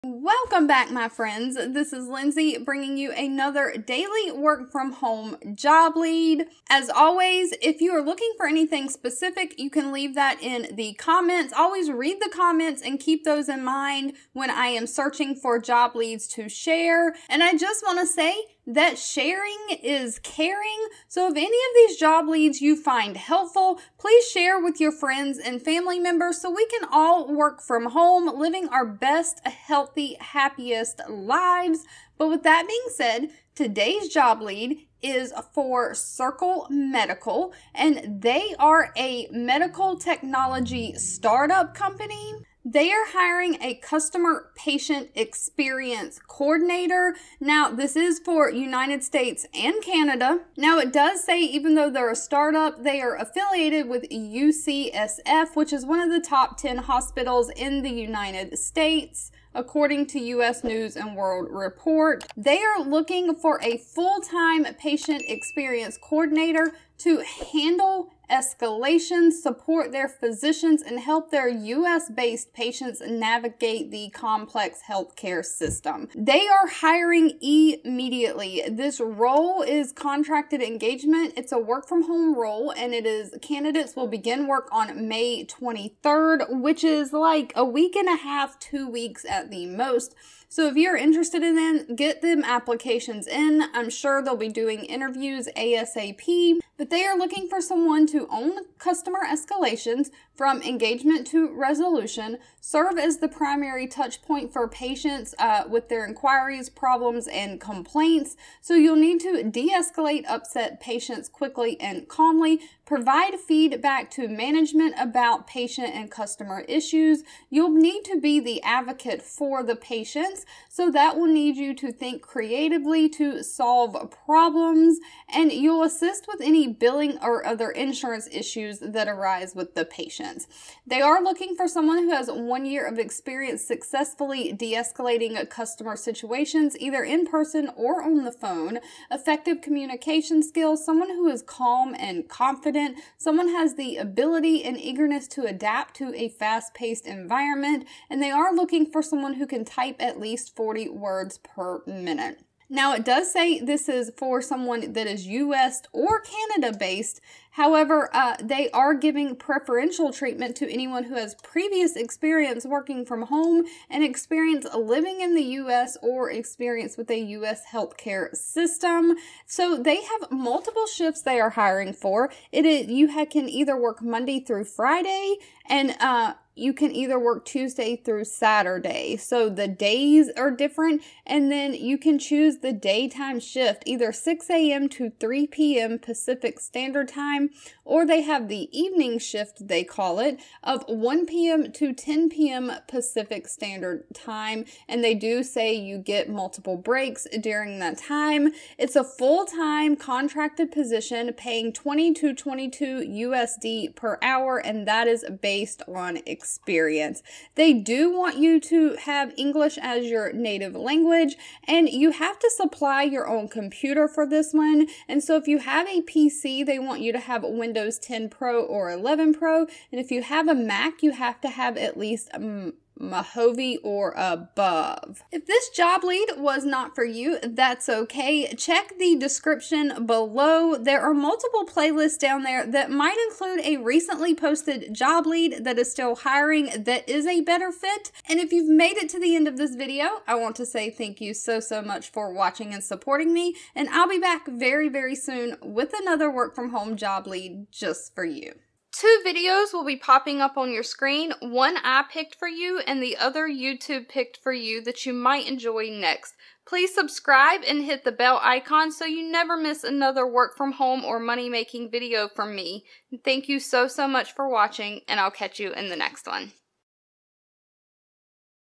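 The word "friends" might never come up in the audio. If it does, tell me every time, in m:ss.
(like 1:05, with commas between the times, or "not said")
0:01, 0:24.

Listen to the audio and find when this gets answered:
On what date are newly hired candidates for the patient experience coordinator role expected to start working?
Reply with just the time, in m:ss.
1:25.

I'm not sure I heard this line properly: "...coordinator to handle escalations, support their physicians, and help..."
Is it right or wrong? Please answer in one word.
right.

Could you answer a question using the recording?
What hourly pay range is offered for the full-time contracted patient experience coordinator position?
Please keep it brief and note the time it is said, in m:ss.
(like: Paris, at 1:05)
$20 to $22, at 3:21.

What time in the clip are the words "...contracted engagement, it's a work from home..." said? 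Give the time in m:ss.
1:19.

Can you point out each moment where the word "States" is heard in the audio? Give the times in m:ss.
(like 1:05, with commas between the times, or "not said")
0:49, 0:58.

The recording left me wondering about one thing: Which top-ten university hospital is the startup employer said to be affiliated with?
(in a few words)
UCSF.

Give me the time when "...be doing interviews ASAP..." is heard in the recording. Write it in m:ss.
1:34.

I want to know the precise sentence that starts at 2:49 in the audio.
So they have multiple shifts they are hiring for.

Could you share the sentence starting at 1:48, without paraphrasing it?
So you'll need to de escalate upset patients quickly and calmly, provide feedback to management about patient and customer issues.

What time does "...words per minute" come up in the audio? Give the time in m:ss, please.
2:30.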